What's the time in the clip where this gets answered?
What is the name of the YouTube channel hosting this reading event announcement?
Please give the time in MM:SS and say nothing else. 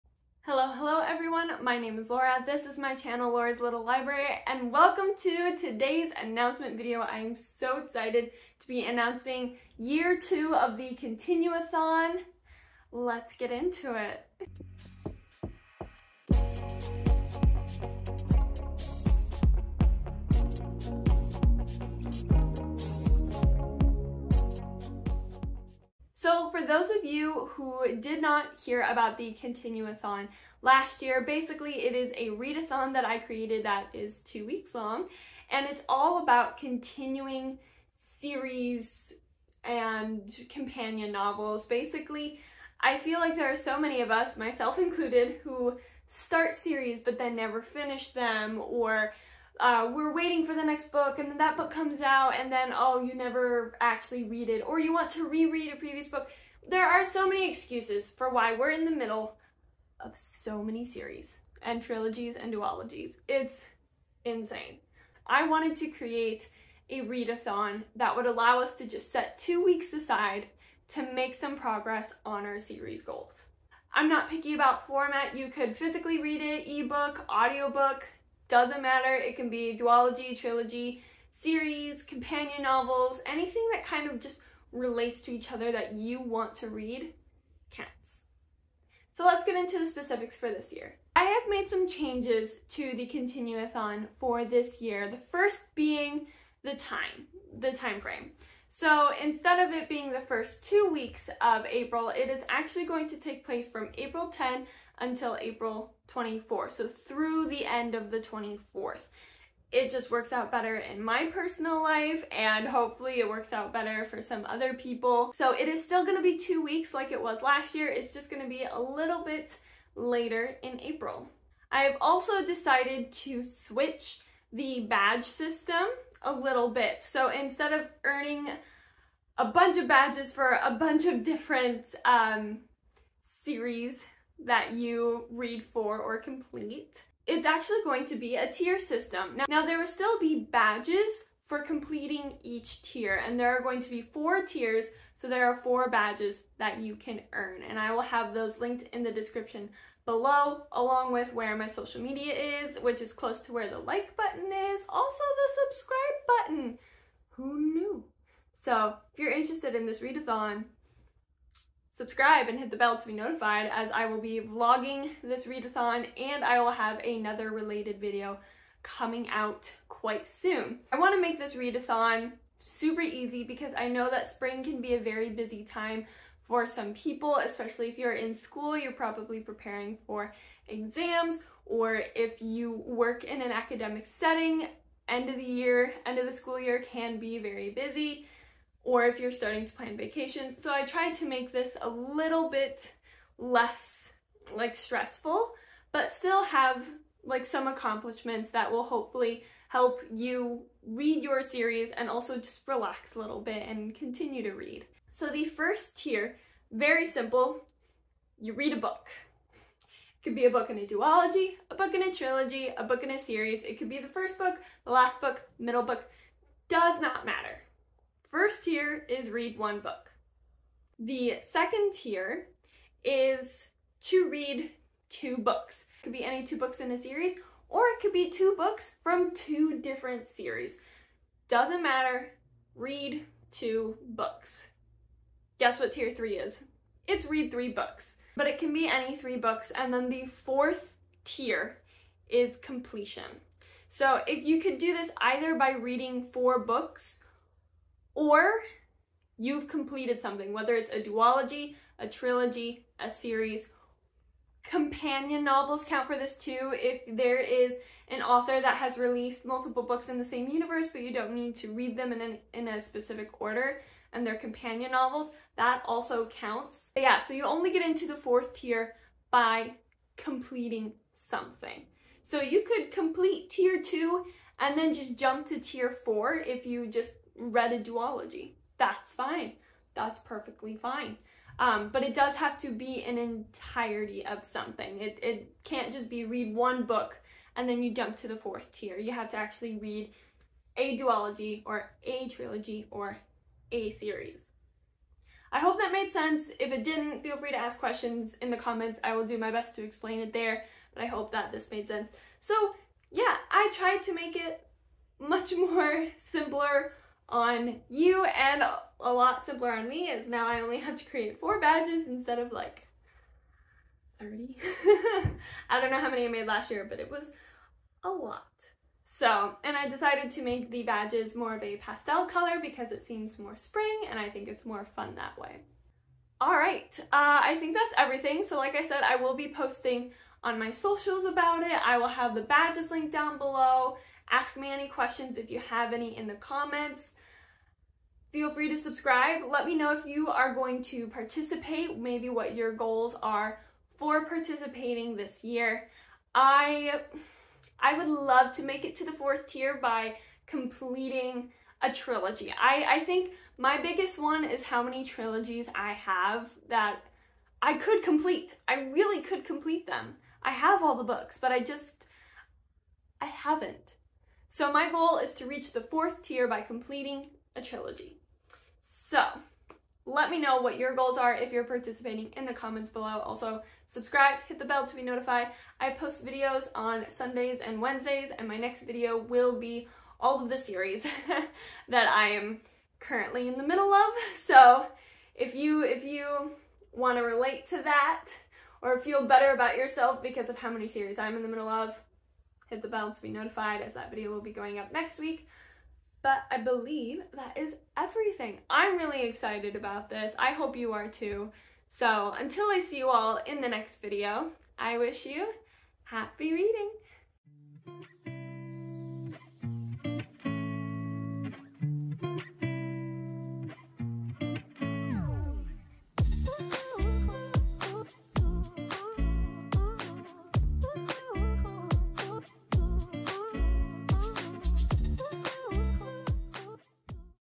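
00:03.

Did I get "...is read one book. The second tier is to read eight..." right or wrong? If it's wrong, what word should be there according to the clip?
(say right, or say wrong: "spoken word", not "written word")
wrong: "two", not "eight".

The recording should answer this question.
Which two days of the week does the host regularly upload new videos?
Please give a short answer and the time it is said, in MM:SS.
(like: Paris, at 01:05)
Sundays and Wednesdays, at 06:17.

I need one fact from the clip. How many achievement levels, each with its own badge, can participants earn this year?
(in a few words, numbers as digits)
4.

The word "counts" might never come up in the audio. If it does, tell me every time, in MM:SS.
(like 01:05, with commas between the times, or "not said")
01:27, 04:15, 04:26.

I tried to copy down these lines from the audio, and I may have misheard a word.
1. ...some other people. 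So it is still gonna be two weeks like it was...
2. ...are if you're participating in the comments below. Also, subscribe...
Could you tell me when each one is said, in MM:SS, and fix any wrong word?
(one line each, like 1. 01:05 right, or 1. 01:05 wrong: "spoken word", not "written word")
1. 01:54 right
2. 06:11 right.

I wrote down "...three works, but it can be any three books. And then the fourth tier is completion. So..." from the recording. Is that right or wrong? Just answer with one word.
wrong.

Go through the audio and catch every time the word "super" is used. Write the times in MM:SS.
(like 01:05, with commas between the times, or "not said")
02:52.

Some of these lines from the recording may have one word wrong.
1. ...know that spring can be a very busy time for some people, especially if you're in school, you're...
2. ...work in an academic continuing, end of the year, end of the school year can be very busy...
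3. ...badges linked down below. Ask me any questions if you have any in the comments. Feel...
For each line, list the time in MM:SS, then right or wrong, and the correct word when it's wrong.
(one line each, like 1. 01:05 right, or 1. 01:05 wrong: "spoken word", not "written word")
1. 02:53 right
2. 03:02 wrong: "setting", not "continuing"
3. 05:32 right.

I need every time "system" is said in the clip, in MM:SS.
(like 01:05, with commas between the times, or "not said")
02:05, 02:18.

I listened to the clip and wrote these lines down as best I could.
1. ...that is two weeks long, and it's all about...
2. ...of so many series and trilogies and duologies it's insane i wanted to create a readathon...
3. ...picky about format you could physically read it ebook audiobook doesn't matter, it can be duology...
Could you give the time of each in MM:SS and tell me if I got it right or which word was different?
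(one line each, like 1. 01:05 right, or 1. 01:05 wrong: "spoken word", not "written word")
1. 00:33 right
2. 00:59 right
3. 01:14 right.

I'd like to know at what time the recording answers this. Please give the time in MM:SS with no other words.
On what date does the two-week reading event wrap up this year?
01:45.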